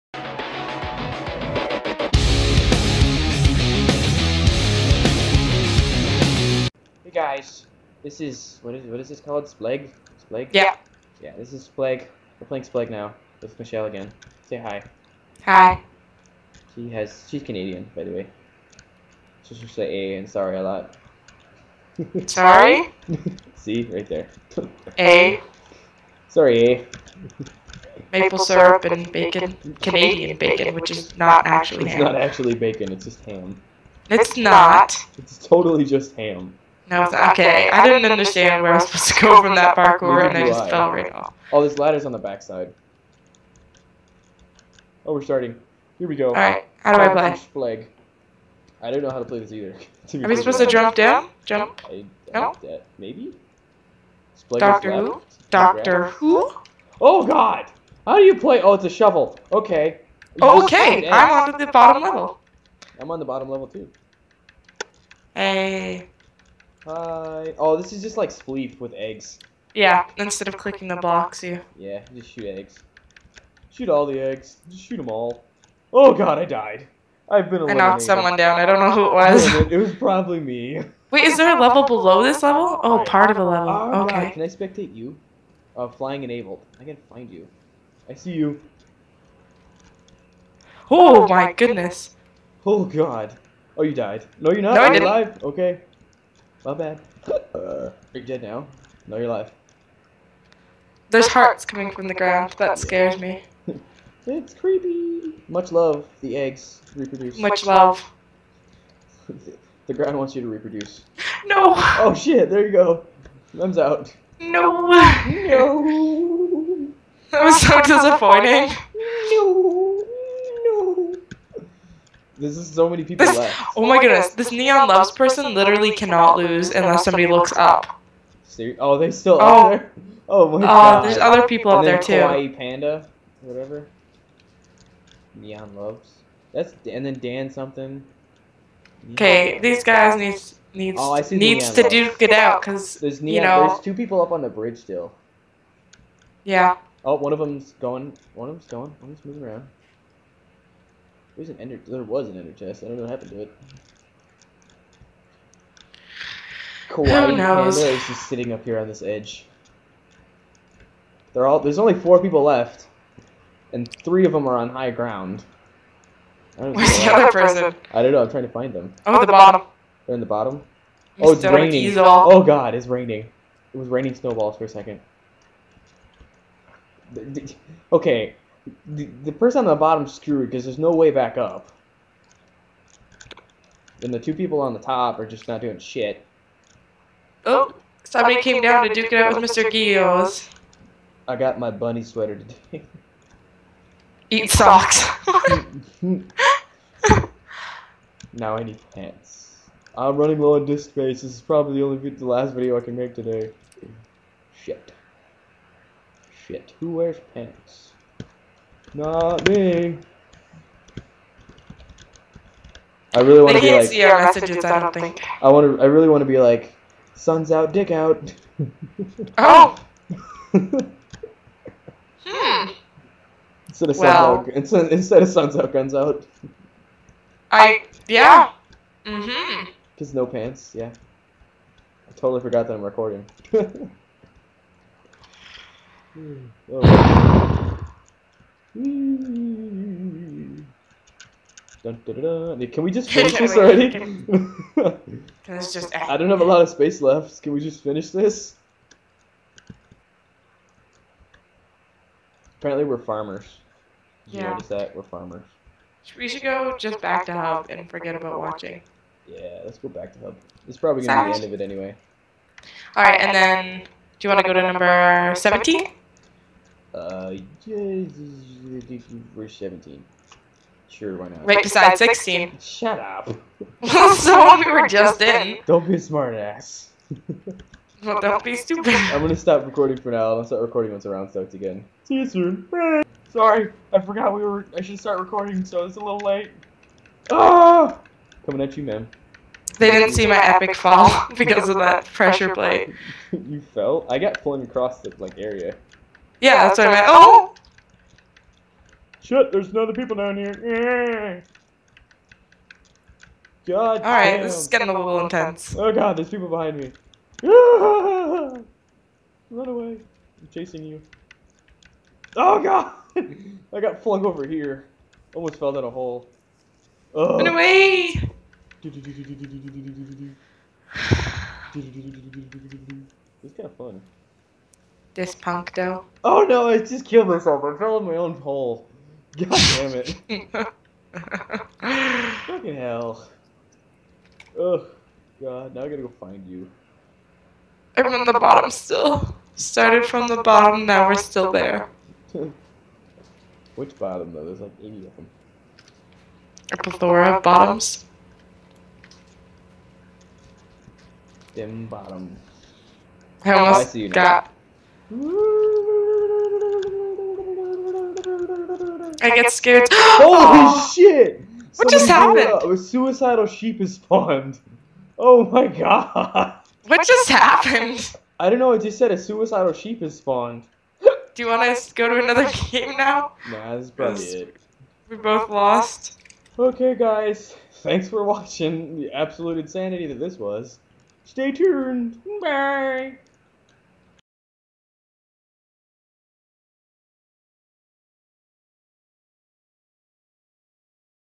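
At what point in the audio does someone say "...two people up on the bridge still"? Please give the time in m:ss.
2:23.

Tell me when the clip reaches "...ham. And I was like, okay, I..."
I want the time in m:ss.
0:36.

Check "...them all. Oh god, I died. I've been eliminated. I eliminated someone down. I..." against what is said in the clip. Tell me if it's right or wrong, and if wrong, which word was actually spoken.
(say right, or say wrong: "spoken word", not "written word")
wrong: "knocked", not "eliminated".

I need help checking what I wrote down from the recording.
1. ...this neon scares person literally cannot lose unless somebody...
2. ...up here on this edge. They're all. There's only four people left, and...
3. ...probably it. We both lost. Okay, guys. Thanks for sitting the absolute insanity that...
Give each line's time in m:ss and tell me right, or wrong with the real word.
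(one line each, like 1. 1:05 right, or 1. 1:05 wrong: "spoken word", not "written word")
1. 2:04 wrong: "loves", not "scares"
2. 2:38 right
3. 6:13 wrong: "watching", not "sitting".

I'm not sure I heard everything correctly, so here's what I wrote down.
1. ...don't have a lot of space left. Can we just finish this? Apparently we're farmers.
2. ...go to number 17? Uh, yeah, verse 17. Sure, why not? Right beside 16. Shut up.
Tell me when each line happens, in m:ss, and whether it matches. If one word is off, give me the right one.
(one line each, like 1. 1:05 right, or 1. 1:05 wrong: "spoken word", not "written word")
1. 4:06 right
2. 4:24 right.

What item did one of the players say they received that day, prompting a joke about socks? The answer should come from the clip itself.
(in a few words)
Bunny sweater.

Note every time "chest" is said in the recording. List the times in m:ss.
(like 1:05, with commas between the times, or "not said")
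2:32.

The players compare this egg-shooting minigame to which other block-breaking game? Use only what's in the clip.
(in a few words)
Spleef.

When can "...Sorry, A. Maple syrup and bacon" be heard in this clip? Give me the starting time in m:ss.
0:26.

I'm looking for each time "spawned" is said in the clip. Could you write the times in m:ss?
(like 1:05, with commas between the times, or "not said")
6:03, 6:10.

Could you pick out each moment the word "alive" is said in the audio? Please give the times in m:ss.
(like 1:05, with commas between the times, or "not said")
1:35, 1:39.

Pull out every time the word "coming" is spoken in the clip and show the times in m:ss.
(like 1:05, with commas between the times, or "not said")
1:41, 4:48.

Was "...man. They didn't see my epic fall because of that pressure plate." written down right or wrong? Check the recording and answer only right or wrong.
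right.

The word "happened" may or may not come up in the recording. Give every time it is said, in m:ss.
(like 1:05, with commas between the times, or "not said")
2:33, 6:02, 6:07.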